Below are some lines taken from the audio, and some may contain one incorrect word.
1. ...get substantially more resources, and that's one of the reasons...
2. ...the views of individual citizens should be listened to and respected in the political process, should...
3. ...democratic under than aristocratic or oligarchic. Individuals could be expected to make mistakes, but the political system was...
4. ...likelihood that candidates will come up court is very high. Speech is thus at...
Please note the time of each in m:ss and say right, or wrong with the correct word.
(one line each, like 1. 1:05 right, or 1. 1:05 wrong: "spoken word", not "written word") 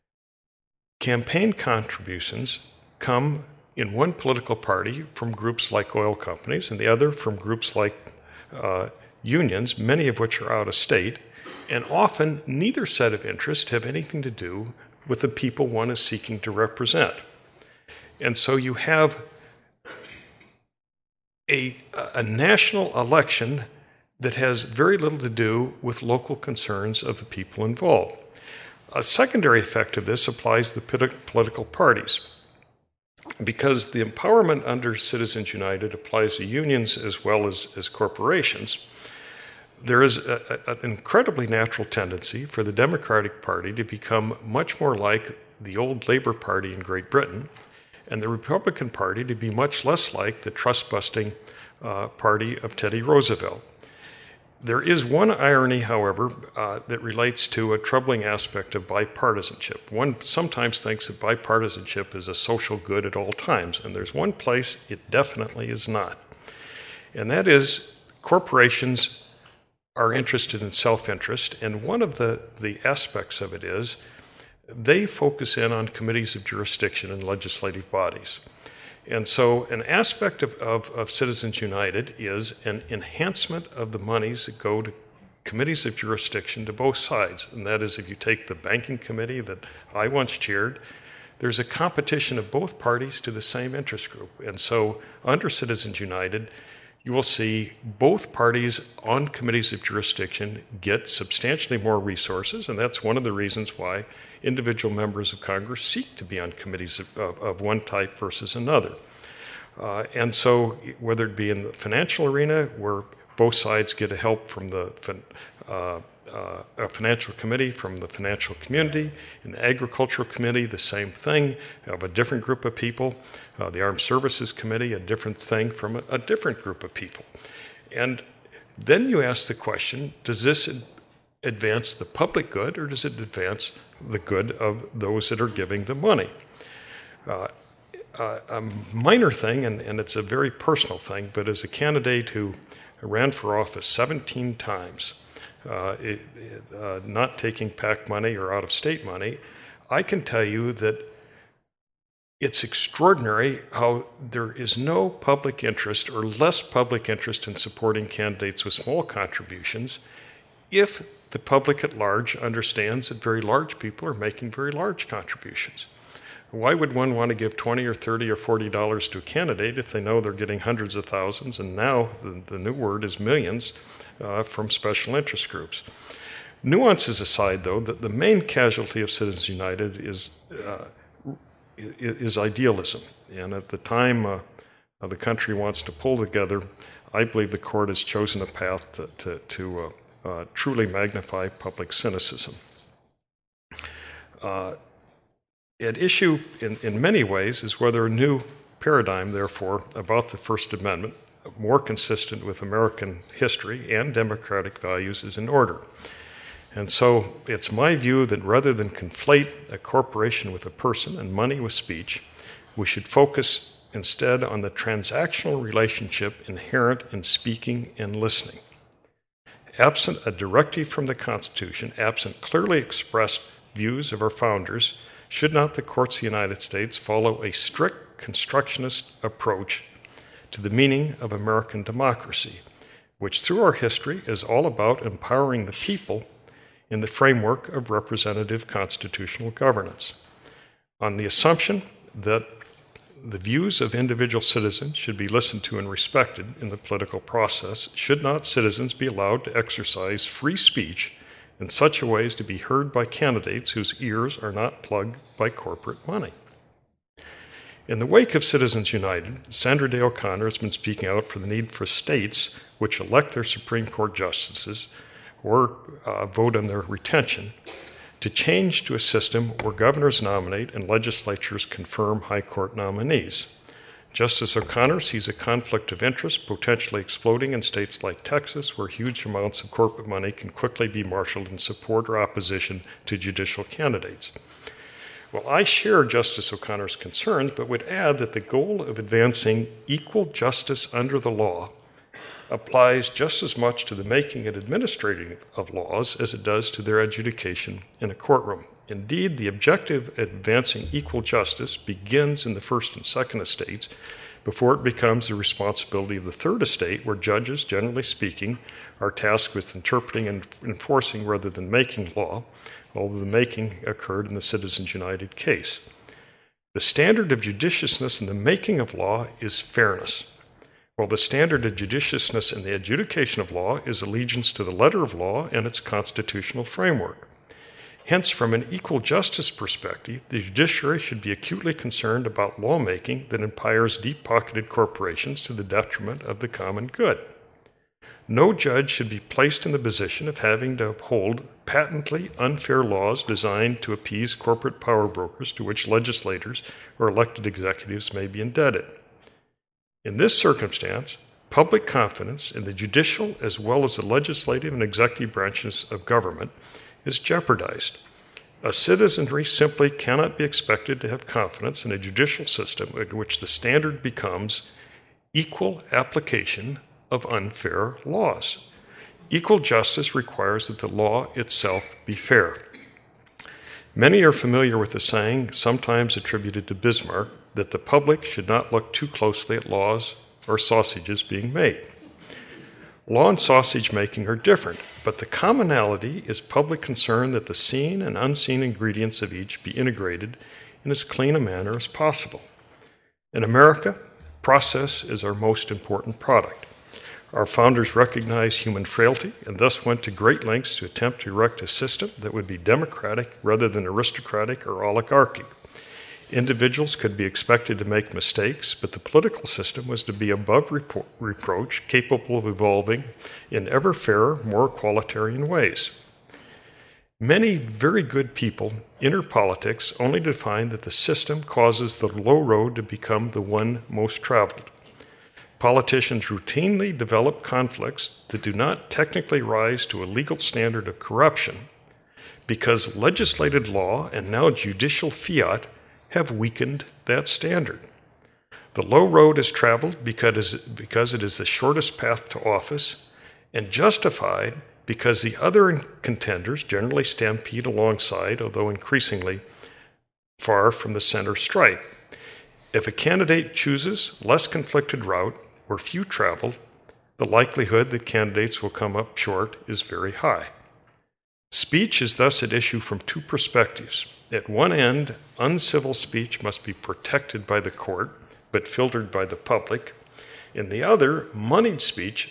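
1. 1:40 right
2. 4:03 right
3. 6:42 wrong: "rather", not "under"
4. 7:37 wrong: "short", not "court".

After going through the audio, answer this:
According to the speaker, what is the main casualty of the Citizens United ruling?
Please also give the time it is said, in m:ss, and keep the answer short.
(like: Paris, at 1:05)
Idealism, at 3:02.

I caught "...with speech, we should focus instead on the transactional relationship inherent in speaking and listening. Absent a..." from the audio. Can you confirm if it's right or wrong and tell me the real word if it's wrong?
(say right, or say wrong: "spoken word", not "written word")
right.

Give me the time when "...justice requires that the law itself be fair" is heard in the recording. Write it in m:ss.
6:09.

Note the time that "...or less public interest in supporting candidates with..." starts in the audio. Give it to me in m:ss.
2:36.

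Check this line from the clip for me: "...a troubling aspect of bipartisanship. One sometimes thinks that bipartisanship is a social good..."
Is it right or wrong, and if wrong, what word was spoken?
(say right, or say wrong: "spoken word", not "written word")
right.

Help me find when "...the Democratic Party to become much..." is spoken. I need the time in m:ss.
0:42.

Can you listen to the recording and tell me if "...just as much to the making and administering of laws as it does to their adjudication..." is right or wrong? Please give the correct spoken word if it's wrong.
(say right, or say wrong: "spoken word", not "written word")
right.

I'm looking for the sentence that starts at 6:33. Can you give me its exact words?
In America, process is our most important product.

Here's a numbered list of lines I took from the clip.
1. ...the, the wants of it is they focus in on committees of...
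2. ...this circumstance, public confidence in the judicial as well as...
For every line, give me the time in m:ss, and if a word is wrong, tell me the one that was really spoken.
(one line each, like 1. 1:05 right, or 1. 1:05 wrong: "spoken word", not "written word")
1. 1:12 wrong: "aspects", not "wants"
2. 5:50 right.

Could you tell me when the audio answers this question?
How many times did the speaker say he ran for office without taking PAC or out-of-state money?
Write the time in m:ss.
2:23.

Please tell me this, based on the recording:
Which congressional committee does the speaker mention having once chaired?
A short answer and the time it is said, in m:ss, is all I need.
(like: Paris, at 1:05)
Banking committee, at 1:28.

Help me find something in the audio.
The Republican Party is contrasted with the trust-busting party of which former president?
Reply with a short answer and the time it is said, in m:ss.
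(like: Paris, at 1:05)
Teddy Roosevelt, at 0:52.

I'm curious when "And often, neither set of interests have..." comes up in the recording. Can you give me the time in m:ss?
0:11.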